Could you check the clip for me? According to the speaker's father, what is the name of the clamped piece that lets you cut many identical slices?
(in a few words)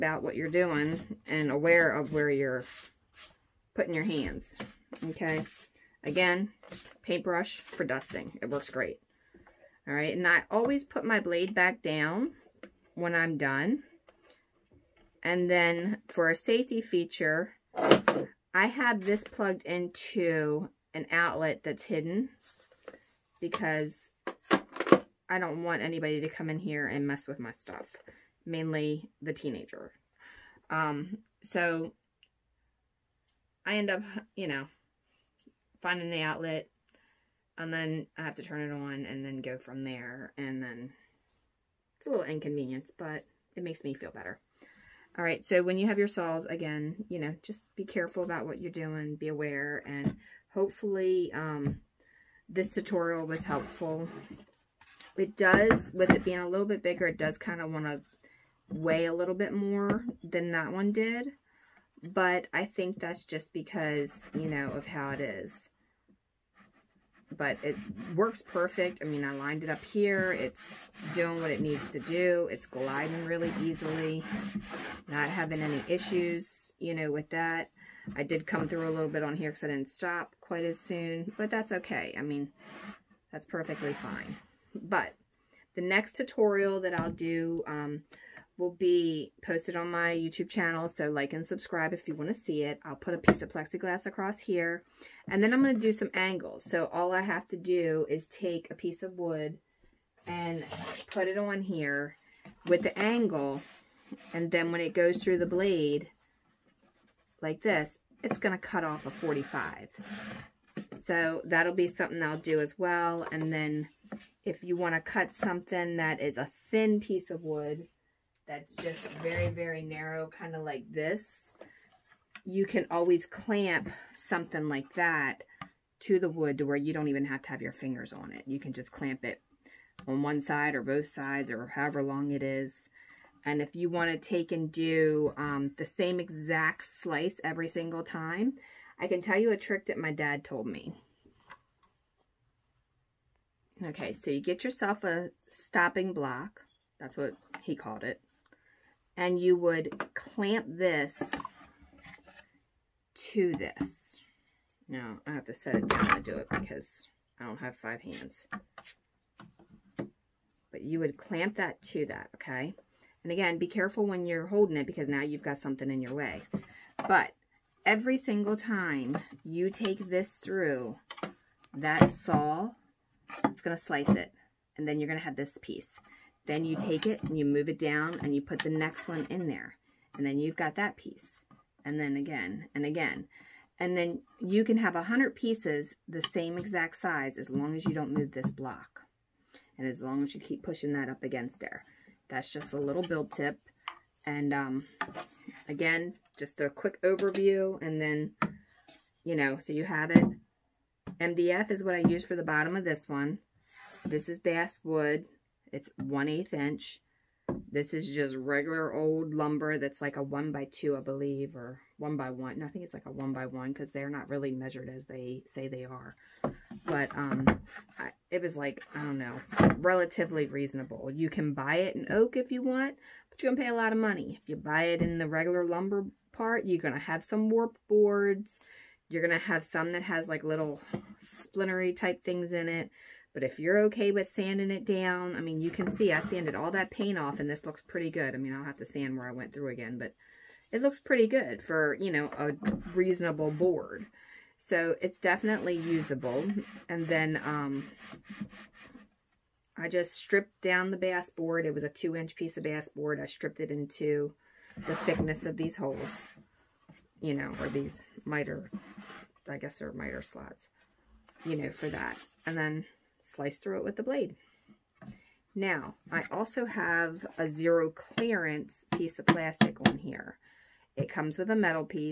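Stopping block.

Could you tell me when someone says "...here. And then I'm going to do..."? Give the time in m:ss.
1:34.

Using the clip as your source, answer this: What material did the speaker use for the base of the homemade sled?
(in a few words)
MDF.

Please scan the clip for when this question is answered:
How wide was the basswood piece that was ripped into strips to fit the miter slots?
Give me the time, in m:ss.
4:11.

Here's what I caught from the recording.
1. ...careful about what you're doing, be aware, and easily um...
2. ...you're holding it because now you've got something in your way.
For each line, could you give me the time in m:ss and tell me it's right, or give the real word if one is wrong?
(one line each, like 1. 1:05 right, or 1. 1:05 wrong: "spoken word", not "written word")
1. 0:47 wrong: "hopefully", not "easily"
2. 2:44 right.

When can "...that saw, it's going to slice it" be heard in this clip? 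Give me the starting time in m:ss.
2:51.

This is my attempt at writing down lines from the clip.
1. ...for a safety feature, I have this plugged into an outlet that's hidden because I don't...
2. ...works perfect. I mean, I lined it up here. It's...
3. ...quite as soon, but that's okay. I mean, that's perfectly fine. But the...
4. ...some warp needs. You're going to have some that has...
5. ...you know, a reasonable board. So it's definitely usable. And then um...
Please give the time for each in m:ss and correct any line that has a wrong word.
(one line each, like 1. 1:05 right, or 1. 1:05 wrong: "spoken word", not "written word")
1. 0:16 right
2. 1:08 right
3. 1:20 right
4. 3:47 wrong: "boards", not "needs"
5. 4:01 right.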